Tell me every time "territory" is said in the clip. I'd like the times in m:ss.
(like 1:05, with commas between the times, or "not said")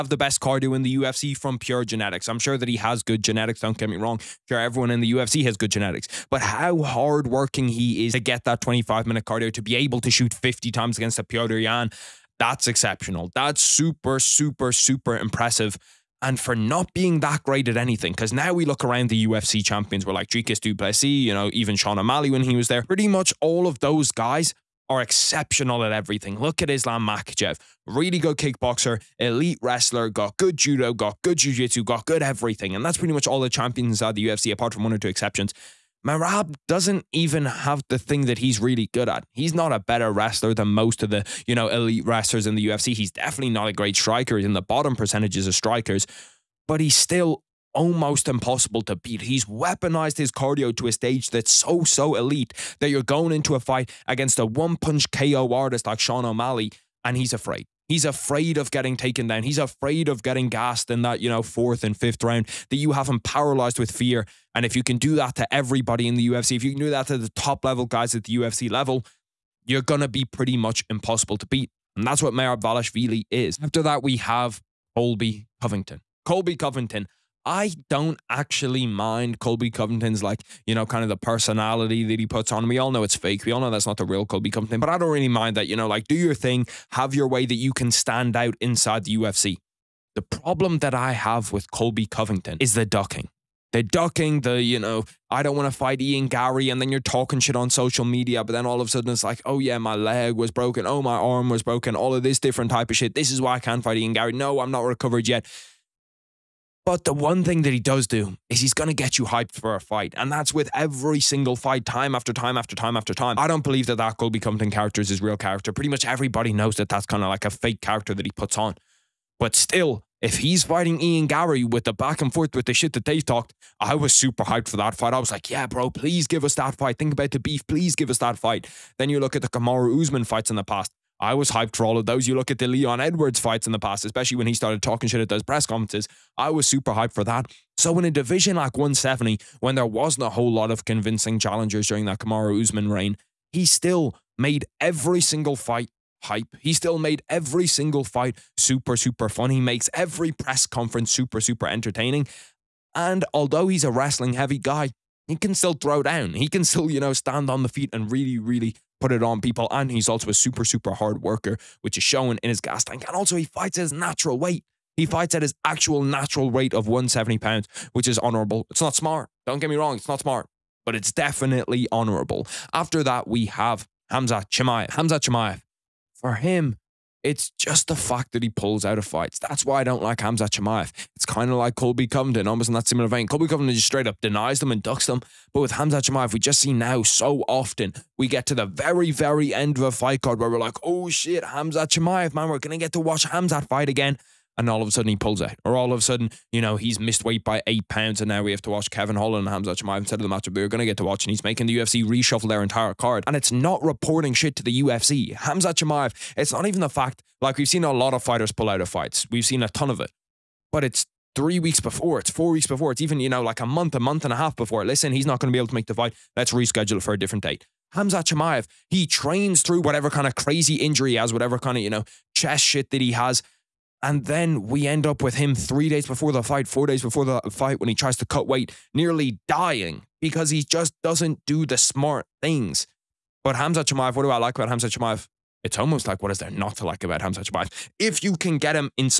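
not said.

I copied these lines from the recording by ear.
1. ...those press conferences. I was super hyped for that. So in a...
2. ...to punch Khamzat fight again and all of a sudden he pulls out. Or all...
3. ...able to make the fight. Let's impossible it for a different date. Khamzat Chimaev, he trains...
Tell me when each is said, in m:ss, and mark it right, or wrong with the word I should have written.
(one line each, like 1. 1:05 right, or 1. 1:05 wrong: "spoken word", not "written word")
1. 2:15 right
2. 3:12 wrong: "watch", not "punch"
3. 3:35 wrong: "reschedule", not "impossible".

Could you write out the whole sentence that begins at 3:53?
But Khamzat Chimaev, what do I like about Khamzat Chimaev?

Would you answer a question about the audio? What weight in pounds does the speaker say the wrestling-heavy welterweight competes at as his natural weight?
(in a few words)
170.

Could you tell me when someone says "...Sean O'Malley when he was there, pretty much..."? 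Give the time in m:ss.
0:21.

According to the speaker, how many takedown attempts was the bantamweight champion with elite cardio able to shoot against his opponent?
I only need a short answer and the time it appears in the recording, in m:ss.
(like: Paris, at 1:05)
50, at 0:10.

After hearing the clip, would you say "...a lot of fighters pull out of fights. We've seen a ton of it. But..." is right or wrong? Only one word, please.
right.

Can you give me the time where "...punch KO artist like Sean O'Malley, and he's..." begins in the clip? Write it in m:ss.
0:54.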